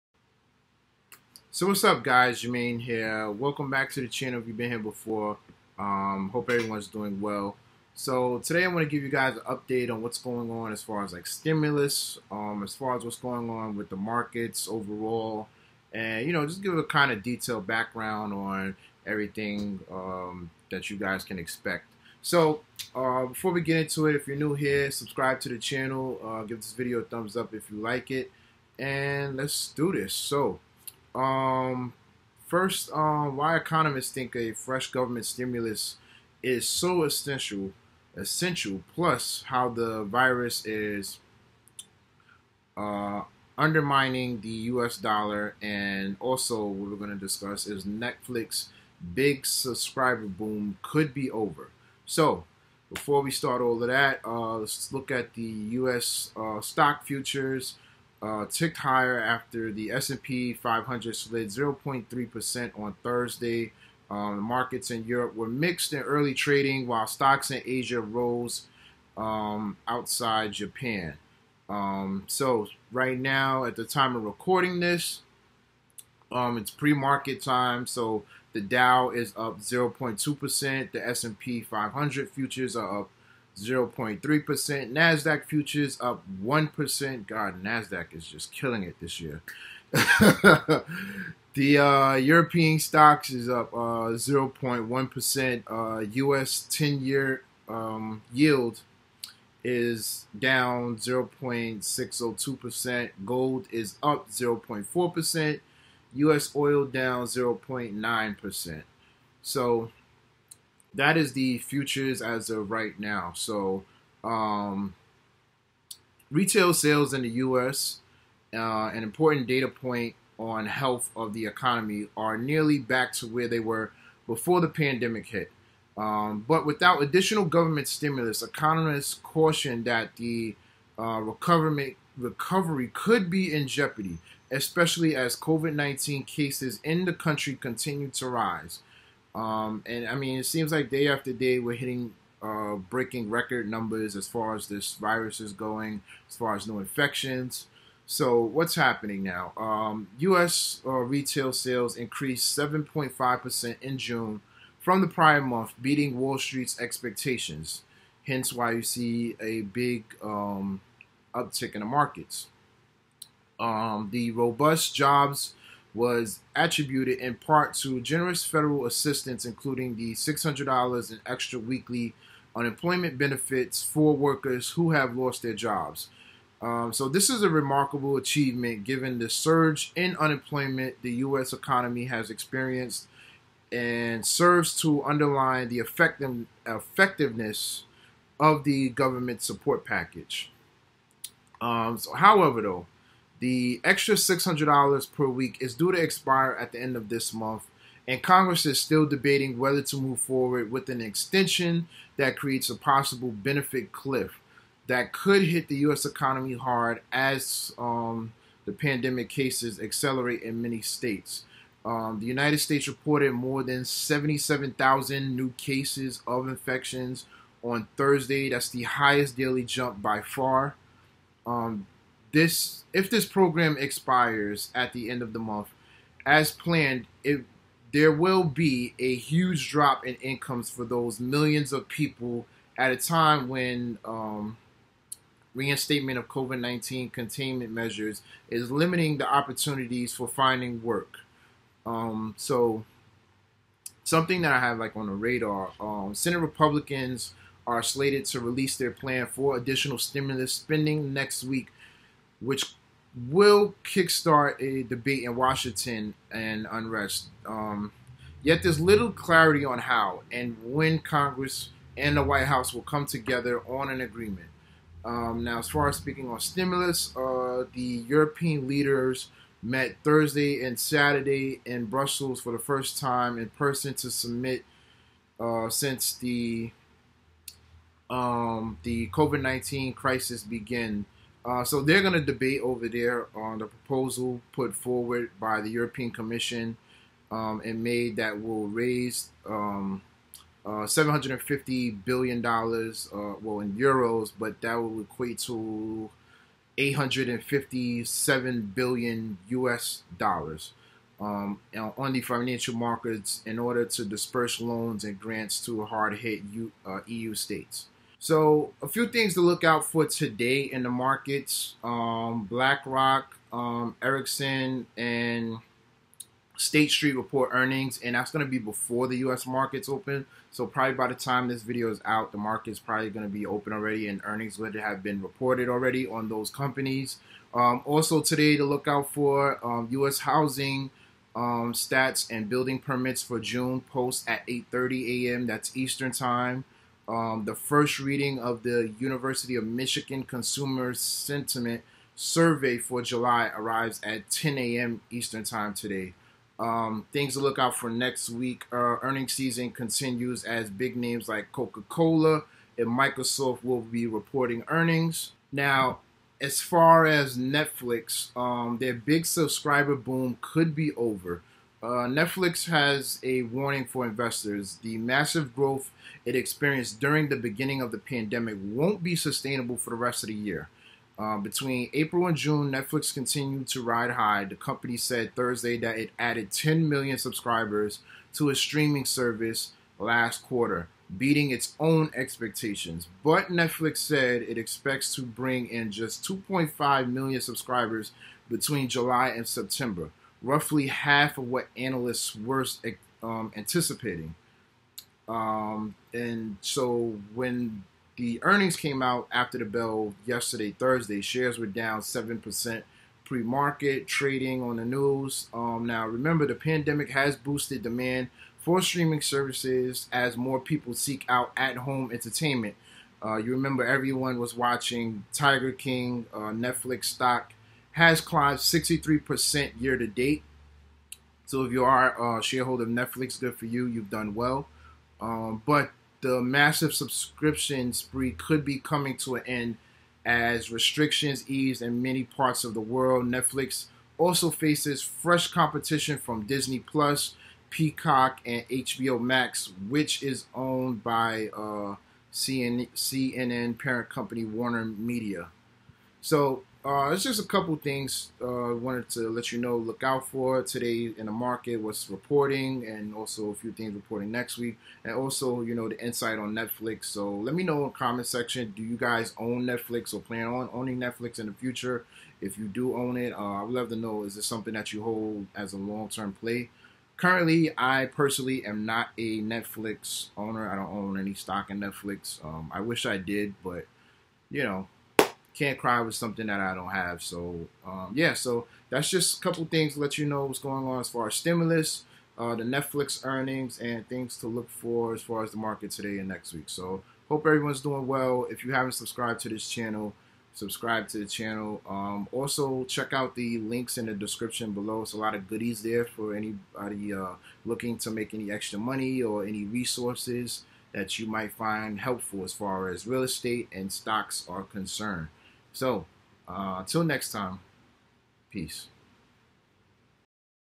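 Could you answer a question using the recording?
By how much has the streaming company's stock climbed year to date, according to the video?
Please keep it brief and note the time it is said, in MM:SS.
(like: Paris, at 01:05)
63%, at 06:58.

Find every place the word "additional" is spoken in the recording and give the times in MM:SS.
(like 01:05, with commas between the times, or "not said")
02:07, 04:09.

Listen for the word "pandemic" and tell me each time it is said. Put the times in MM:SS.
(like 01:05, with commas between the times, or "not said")
02:04, 03:28, 06:07, 06:46.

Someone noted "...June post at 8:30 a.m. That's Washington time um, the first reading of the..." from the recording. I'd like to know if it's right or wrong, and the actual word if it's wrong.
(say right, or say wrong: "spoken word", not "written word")
wrong: "Eastern", not "Washington".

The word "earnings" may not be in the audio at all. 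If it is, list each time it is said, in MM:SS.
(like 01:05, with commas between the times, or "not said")
05:17, 05:24, 05:49, 05:54, 06:38, 08:03.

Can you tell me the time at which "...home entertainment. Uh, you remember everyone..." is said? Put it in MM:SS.
06:51.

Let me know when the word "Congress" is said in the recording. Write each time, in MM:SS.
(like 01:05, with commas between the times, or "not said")
03:18, 04:20.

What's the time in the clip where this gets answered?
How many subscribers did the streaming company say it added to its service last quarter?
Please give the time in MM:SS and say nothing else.
06:16.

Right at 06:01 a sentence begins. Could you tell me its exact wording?
Uh, Netflix has a warning for investors.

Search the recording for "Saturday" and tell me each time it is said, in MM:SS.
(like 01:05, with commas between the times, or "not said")
04:30.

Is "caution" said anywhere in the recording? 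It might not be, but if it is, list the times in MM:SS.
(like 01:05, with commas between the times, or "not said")
02:09.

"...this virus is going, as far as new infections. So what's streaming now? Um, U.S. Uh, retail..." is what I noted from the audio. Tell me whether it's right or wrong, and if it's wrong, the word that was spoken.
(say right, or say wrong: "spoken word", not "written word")
wrong: "happening", not "streaming".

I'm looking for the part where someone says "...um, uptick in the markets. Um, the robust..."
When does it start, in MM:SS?
02:40.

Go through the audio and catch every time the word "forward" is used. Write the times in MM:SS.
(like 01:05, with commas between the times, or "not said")
03:20, 04:44.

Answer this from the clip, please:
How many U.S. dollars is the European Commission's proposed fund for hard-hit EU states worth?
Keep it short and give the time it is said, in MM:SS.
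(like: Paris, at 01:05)
857 billion, at 04:56.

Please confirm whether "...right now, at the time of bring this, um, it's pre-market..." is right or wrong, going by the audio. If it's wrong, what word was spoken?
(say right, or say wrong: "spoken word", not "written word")
wrong: "recording", not "bring".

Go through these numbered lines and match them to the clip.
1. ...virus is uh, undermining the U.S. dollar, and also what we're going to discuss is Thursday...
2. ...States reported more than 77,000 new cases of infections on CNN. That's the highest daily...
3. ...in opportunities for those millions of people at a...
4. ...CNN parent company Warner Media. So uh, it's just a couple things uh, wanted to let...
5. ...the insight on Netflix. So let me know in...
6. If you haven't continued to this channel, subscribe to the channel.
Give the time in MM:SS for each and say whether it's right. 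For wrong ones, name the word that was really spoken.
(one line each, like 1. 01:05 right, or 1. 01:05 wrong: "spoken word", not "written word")
1. 00:40 wrong: "Netflix", not "Thursday"
2. 03:32 wrong: "Thursday", not "CNN"
3. 03:50 wrong: "incomes", not "opportunities"
4. 07:22 right
5. 07:35 right
6. 08:08 wrong: "subscribed", not "continued".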